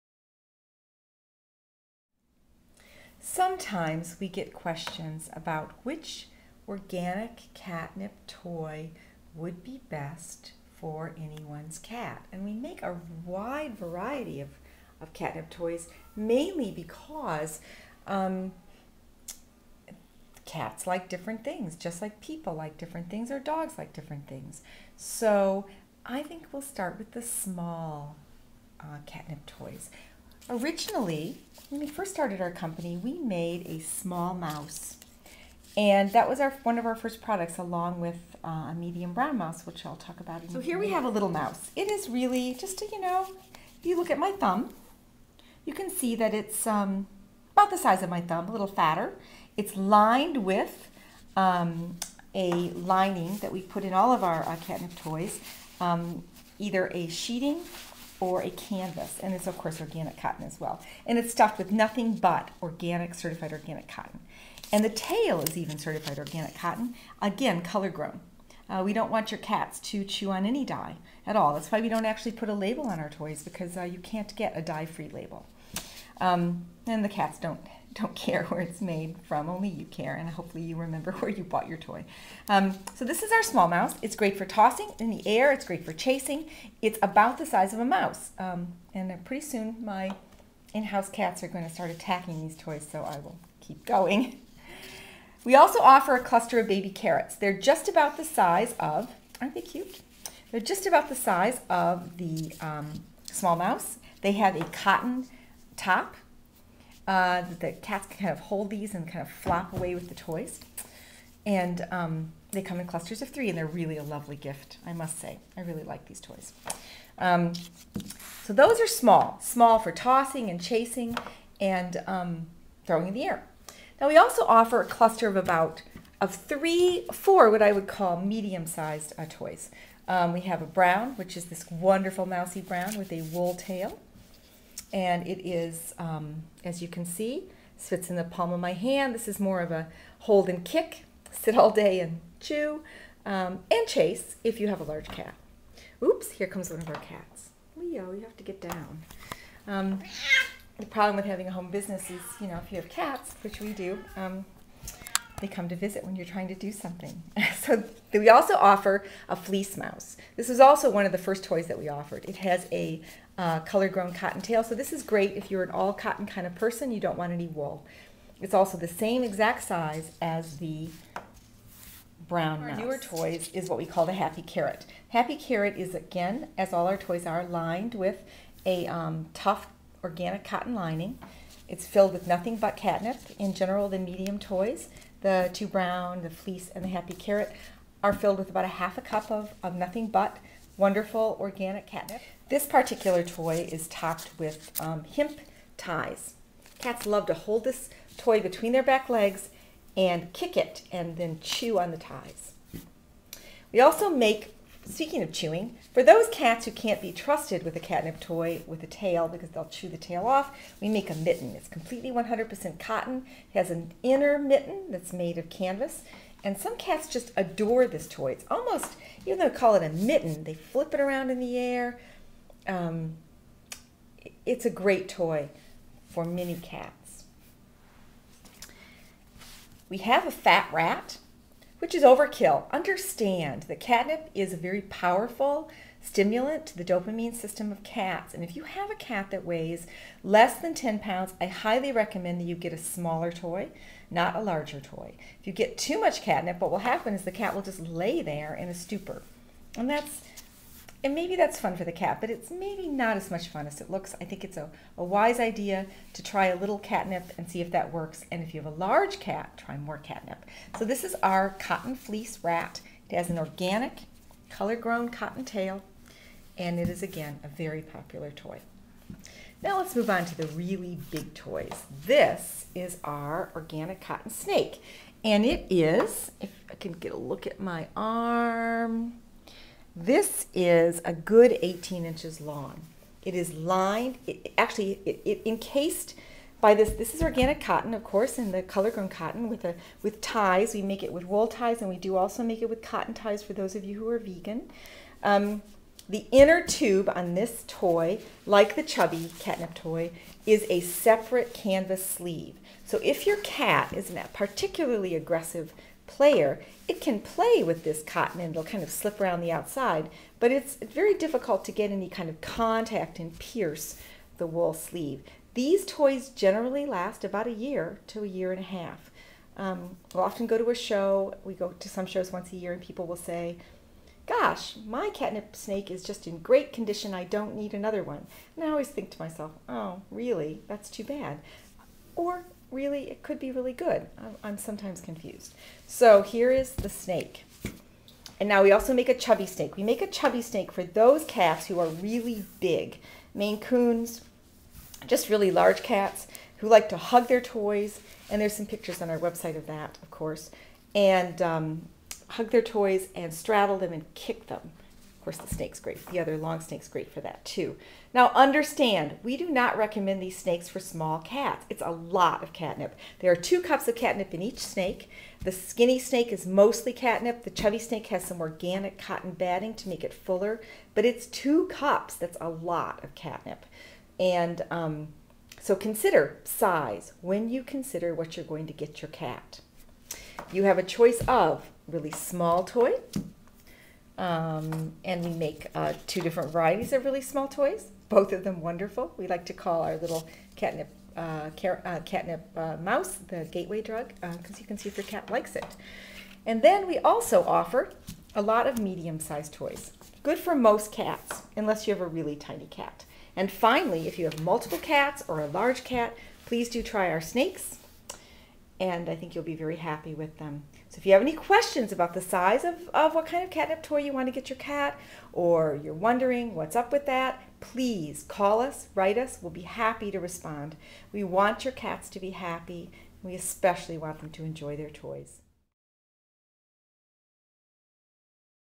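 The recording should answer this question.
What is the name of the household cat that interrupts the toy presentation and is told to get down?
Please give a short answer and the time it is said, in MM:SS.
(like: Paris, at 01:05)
Leo, at 02:27.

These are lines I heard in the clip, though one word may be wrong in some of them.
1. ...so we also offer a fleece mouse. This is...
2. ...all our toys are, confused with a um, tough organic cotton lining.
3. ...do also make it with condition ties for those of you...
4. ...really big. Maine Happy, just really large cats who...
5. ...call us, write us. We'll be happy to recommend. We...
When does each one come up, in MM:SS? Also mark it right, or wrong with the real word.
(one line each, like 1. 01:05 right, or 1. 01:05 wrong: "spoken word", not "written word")
1. 02:37 right
2. 02:56 wrong: "lined", not "confused"
3. 04:51 wrong: "cotton", not "condition"
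4. 05:41 wrong: "Coons", not "Happy"
5. 06:58 wrong: "respond", not "recommend".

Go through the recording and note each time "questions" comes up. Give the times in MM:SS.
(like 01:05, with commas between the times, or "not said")
00:04, 06:51.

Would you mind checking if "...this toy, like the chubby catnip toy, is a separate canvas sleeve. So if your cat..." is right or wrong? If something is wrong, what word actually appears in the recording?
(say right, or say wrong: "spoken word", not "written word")
right.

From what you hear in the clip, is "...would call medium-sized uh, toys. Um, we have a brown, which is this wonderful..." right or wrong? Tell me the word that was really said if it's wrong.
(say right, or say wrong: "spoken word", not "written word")
right.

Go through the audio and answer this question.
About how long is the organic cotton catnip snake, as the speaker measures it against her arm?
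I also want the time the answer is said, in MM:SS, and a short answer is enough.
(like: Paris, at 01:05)
18 inches, at 04:41.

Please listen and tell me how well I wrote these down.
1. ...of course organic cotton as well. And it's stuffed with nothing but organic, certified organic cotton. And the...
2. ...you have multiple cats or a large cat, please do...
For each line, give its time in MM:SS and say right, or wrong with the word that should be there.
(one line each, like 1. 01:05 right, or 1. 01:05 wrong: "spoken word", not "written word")
1. 00:59 right
2. 06:44 right.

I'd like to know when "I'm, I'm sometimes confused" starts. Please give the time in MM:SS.
05:34.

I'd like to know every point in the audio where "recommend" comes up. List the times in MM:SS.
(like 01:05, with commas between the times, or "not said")
04:01, 05:59.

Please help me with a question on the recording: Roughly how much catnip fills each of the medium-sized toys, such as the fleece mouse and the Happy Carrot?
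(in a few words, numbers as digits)
half a cup.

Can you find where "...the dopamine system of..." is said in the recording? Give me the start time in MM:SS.
03:56.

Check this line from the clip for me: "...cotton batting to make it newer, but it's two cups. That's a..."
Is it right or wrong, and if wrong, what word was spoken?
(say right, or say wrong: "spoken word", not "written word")
wrong: "fuller", not "newer".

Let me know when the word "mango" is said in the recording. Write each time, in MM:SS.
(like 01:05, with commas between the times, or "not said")
not said.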